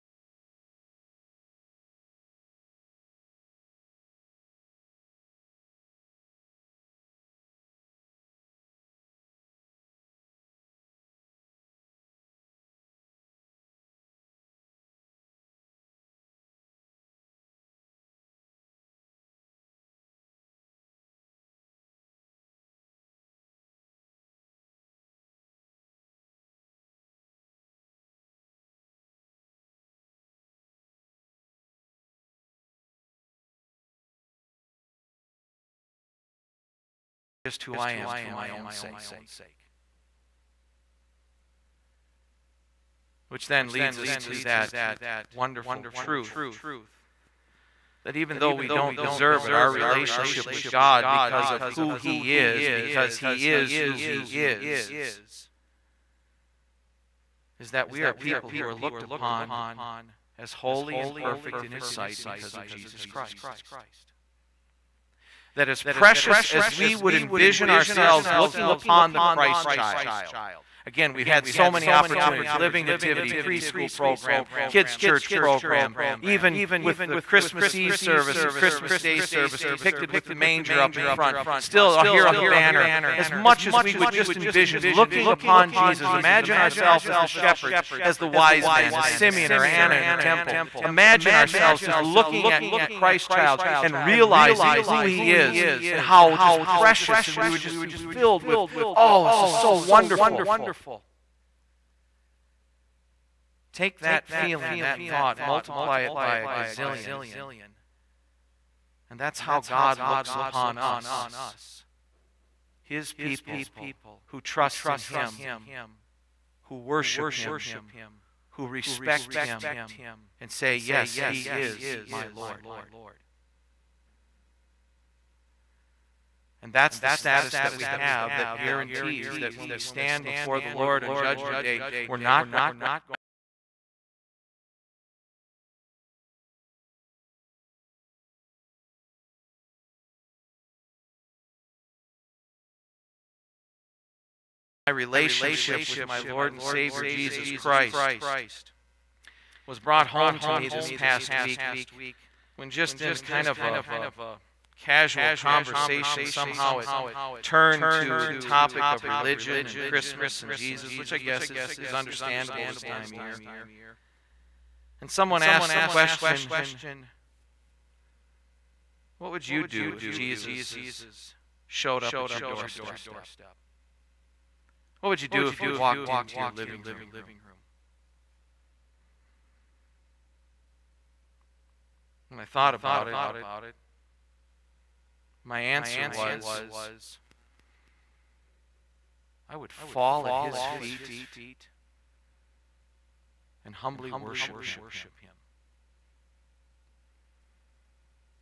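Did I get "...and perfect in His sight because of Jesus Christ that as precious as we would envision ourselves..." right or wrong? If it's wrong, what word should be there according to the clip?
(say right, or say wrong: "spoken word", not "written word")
right.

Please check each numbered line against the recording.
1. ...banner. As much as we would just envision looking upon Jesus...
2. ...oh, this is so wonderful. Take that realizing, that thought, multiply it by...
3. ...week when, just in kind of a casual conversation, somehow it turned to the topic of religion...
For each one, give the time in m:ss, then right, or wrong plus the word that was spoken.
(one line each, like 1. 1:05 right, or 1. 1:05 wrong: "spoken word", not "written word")
1. 1:22 right
2. 1:38 wrong: "feeling", not "realizing"
3. 2:31 right.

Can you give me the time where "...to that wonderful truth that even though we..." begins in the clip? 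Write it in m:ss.
0:44.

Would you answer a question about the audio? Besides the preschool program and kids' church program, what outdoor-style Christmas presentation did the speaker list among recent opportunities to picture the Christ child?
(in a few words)
Living Nativity.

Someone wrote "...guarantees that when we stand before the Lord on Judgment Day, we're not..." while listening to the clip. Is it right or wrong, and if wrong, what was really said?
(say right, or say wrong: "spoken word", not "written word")
right.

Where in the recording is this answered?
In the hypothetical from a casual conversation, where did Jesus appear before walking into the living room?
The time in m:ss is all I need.
2:52.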